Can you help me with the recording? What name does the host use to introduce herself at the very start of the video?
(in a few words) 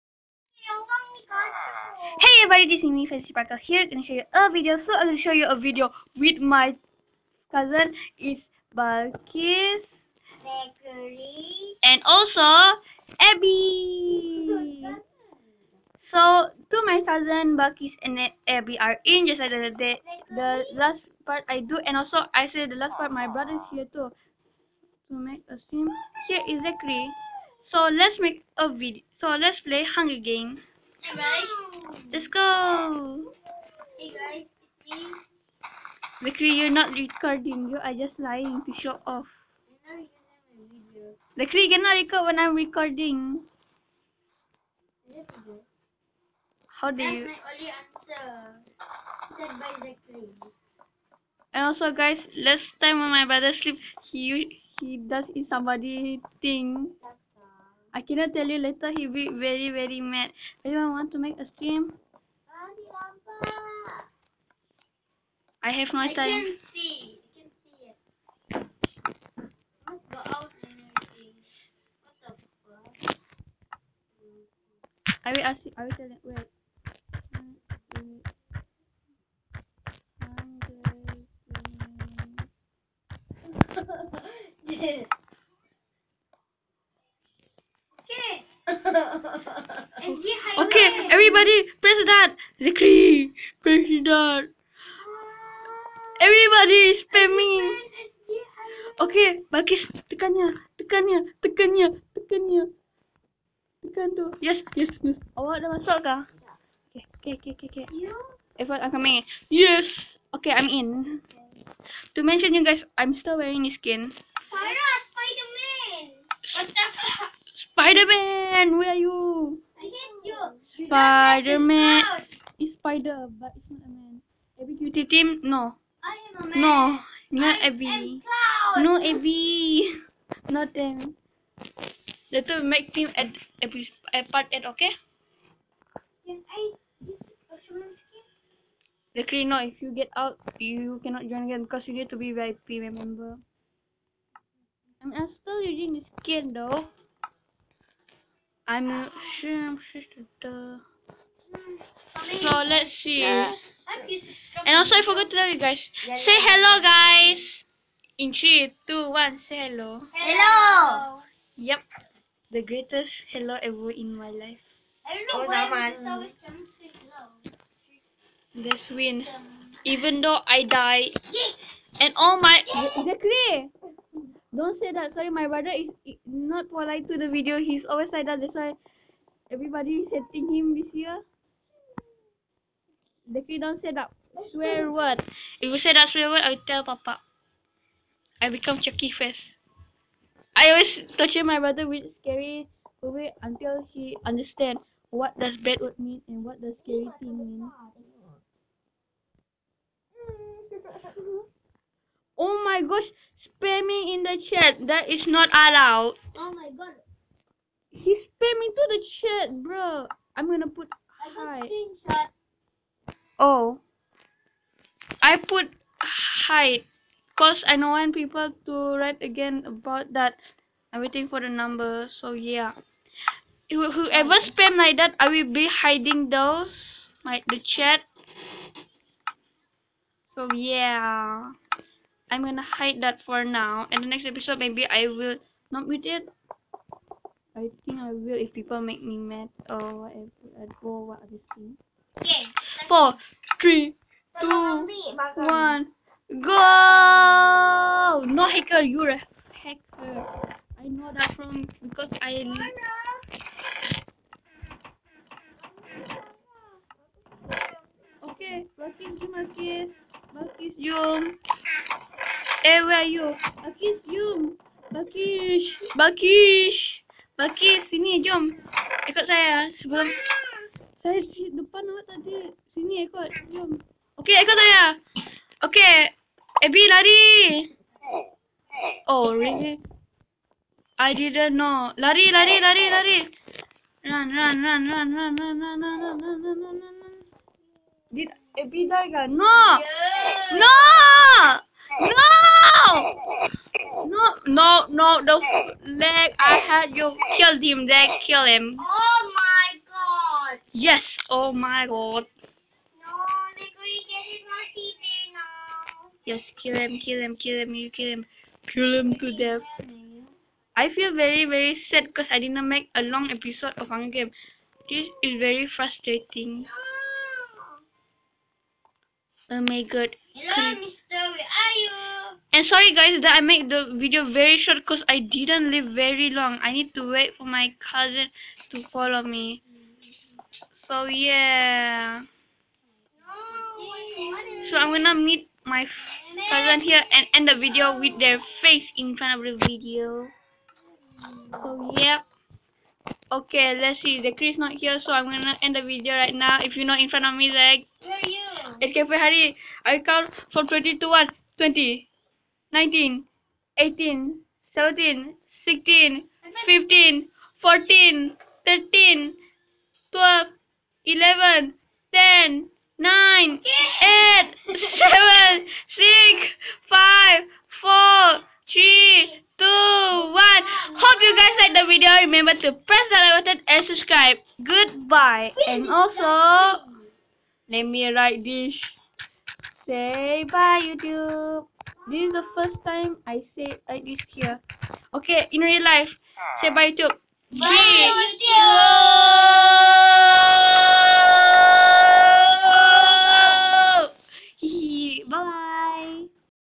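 Fancy Sparkle.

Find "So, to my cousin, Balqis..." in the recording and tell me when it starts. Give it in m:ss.
0:16.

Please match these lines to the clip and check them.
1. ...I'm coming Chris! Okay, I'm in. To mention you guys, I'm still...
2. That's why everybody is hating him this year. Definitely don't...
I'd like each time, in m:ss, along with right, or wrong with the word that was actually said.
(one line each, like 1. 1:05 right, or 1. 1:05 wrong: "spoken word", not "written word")
1. 1:48 wrong: "Yes", not "Chris"
2. 2:58 right.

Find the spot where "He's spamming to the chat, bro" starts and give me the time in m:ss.
3:27.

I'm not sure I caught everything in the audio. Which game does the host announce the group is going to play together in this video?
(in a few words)
Hunger Games.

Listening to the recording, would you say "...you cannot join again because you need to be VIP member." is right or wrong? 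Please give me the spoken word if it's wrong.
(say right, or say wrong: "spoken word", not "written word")
right.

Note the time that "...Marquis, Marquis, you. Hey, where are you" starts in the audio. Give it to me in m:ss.
4:19.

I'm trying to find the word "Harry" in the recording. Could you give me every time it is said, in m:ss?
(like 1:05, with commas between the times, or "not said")
5:49.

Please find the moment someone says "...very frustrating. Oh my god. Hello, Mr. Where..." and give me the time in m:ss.
5:15.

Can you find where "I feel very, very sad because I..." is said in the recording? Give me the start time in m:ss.
5:10.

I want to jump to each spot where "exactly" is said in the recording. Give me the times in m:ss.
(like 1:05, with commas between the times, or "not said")
0:26, 2:52.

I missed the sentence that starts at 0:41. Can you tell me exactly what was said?
Lakri, you cannot record when I'm recording.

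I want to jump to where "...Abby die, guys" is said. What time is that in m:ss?
4:48.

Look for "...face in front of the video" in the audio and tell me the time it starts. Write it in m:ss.
5:38.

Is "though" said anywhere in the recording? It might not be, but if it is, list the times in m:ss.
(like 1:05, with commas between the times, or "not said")
2:26, 2:50.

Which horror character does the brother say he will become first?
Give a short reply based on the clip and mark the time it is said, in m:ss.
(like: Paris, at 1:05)
Chucky, at 3:08.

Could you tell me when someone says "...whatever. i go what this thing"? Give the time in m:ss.
4:00.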